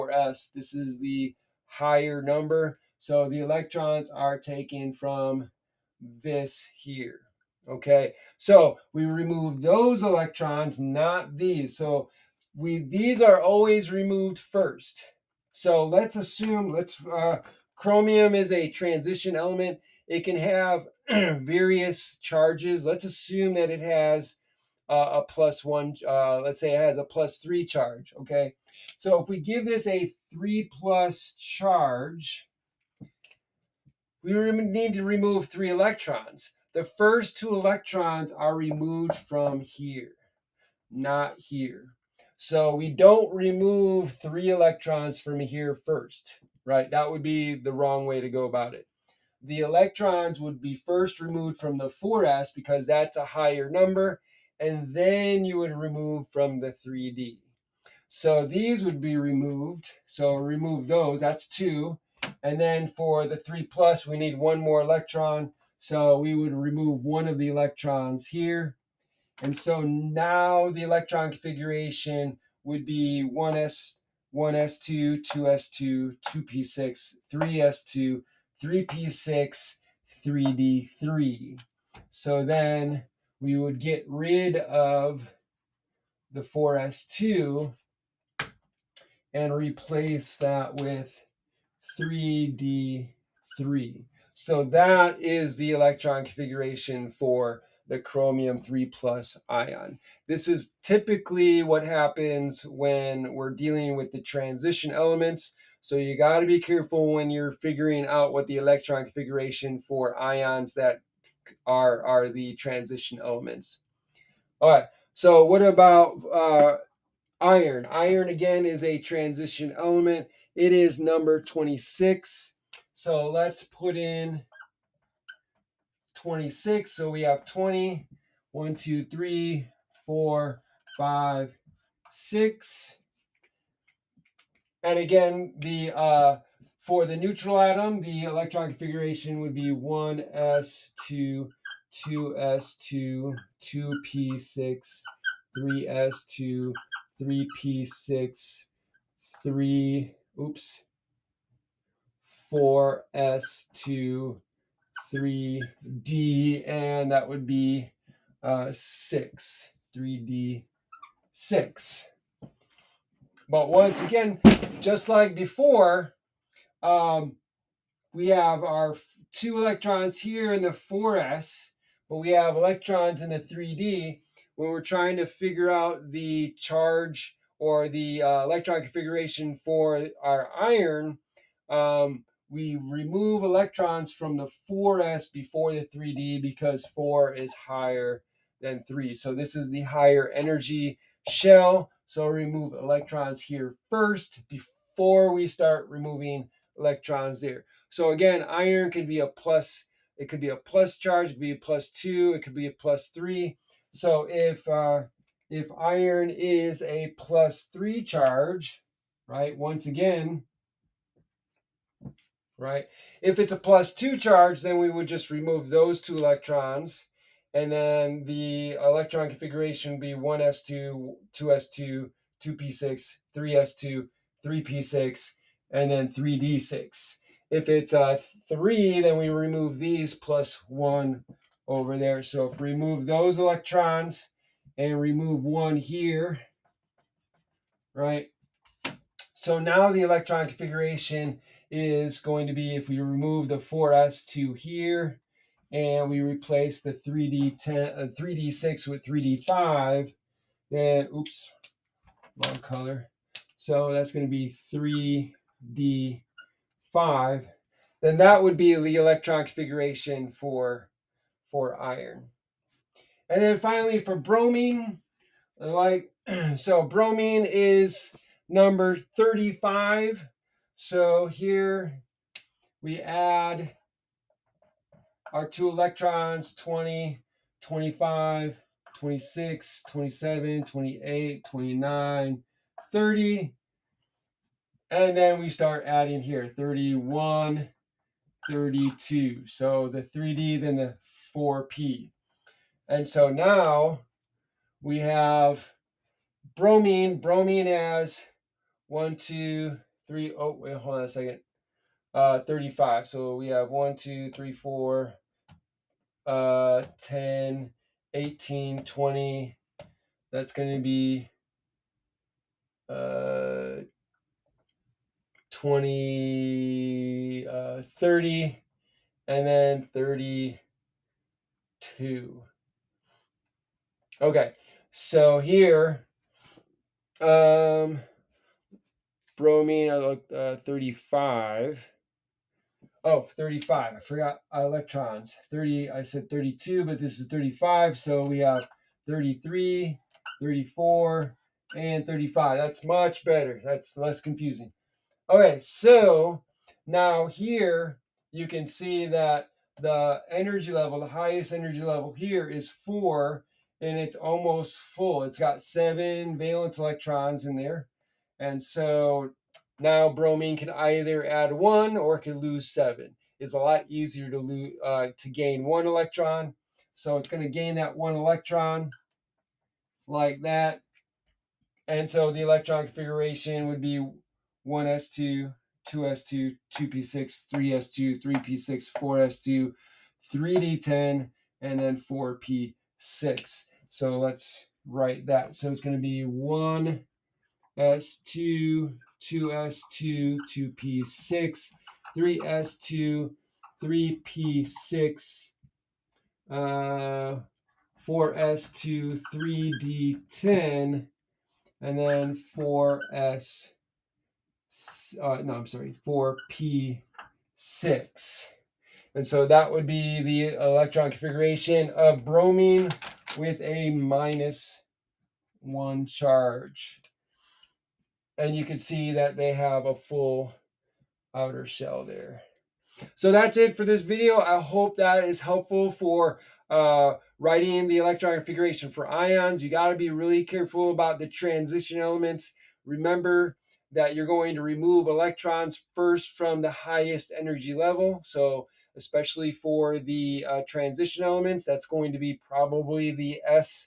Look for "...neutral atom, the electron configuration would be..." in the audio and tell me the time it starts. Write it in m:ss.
2:17.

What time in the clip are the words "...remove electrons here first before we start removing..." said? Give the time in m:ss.
3:12.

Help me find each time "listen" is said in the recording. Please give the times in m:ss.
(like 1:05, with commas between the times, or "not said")
not said.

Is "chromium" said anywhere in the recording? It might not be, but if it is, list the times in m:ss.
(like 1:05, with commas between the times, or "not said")
0:17, 1:37.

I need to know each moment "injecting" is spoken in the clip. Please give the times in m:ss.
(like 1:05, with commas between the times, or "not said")
not said.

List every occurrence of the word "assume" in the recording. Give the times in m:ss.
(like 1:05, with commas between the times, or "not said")
0:16, 0:23.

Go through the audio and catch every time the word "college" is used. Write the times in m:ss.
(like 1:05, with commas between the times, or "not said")
not said.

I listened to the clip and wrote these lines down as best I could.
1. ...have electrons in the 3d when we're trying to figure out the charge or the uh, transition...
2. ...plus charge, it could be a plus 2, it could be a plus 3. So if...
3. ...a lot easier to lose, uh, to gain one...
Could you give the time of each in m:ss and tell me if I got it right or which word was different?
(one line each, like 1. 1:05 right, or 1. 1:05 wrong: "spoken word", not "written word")
1. 2:52 wrong: "electron", not "transition"
2. 3:20 right
3. 6:03 right.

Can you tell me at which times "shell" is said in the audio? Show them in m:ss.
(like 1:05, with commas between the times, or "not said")
3:11, 7:01.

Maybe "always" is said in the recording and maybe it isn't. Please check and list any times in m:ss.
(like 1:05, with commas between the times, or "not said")
0:13.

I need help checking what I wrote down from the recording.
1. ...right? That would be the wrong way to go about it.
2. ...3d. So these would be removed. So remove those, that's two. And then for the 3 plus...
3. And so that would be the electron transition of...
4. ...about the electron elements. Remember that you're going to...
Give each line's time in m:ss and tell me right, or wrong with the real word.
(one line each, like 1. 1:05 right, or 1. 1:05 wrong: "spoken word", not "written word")
1. 0:46 right
2. 0:56 right
3. 6:49 wrong: "configuration", not "transition"
4. 7:10 wrong: "transition", not "electron".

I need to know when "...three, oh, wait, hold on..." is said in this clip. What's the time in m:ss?
5:00.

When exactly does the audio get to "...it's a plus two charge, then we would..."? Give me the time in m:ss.
3:33.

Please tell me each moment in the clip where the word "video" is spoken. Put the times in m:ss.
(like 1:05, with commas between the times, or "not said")
7:04.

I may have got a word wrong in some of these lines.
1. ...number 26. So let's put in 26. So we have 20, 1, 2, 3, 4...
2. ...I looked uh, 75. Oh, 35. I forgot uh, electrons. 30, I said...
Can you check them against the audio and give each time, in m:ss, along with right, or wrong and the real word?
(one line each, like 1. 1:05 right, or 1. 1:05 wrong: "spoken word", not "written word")
1. 2:00 right
2. 5:29 wrong: "35", not "75".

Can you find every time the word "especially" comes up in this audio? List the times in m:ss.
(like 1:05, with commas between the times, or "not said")
7:18.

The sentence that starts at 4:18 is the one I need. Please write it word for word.
Then that would be the electron configuration for for iron.